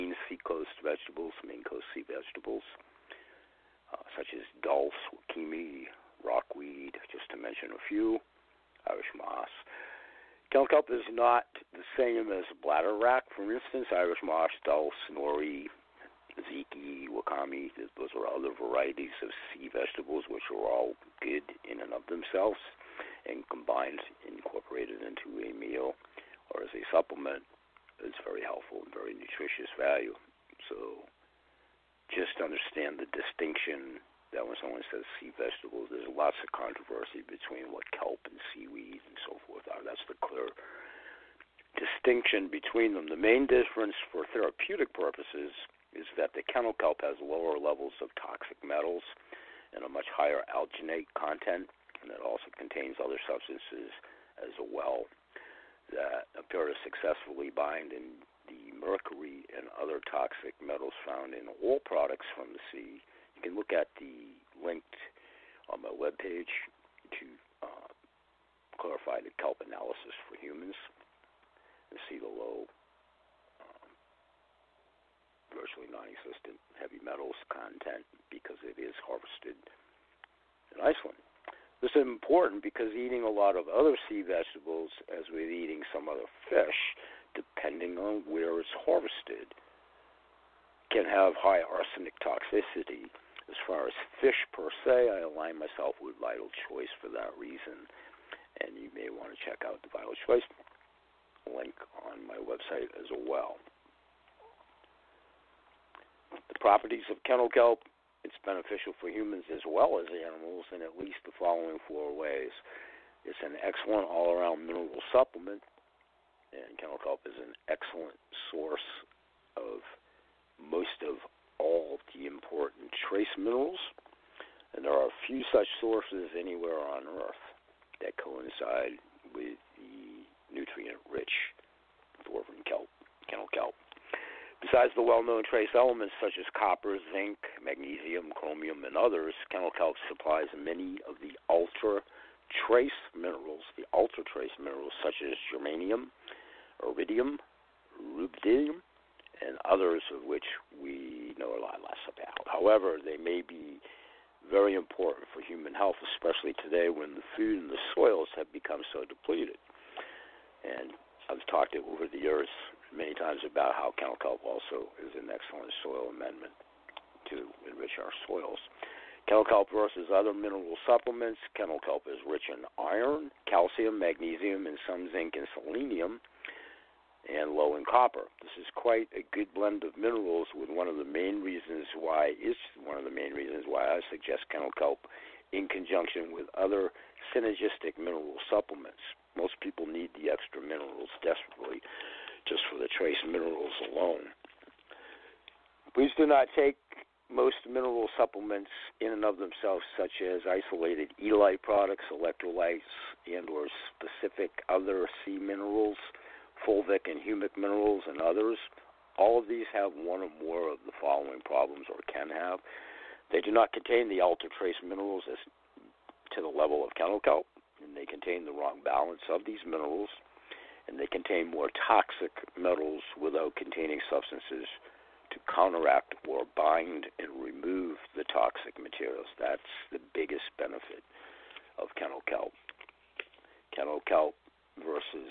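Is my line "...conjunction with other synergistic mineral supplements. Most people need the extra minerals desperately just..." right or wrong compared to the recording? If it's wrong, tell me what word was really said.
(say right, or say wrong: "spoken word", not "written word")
right.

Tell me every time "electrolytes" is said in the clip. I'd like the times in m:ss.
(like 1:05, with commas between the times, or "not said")
3:22.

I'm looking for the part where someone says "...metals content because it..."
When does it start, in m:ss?
1:16.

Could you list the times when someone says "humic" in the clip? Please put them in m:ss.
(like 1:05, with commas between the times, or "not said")
3:27.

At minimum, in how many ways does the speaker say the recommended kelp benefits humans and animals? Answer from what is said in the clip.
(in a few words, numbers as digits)
4.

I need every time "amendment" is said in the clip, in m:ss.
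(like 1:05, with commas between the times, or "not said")
2:46.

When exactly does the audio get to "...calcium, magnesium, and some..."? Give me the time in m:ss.
2:53.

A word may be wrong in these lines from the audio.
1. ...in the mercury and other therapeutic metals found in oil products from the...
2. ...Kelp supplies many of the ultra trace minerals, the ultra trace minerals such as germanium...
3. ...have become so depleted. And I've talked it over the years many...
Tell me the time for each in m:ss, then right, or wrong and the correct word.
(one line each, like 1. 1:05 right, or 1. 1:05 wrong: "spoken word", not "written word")
1. 0:57 wrong: "toxic", not "therapeutic"
2. 2:19 right
3. 2:38 right.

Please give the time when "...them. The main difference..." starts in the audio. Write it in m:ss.
0:42.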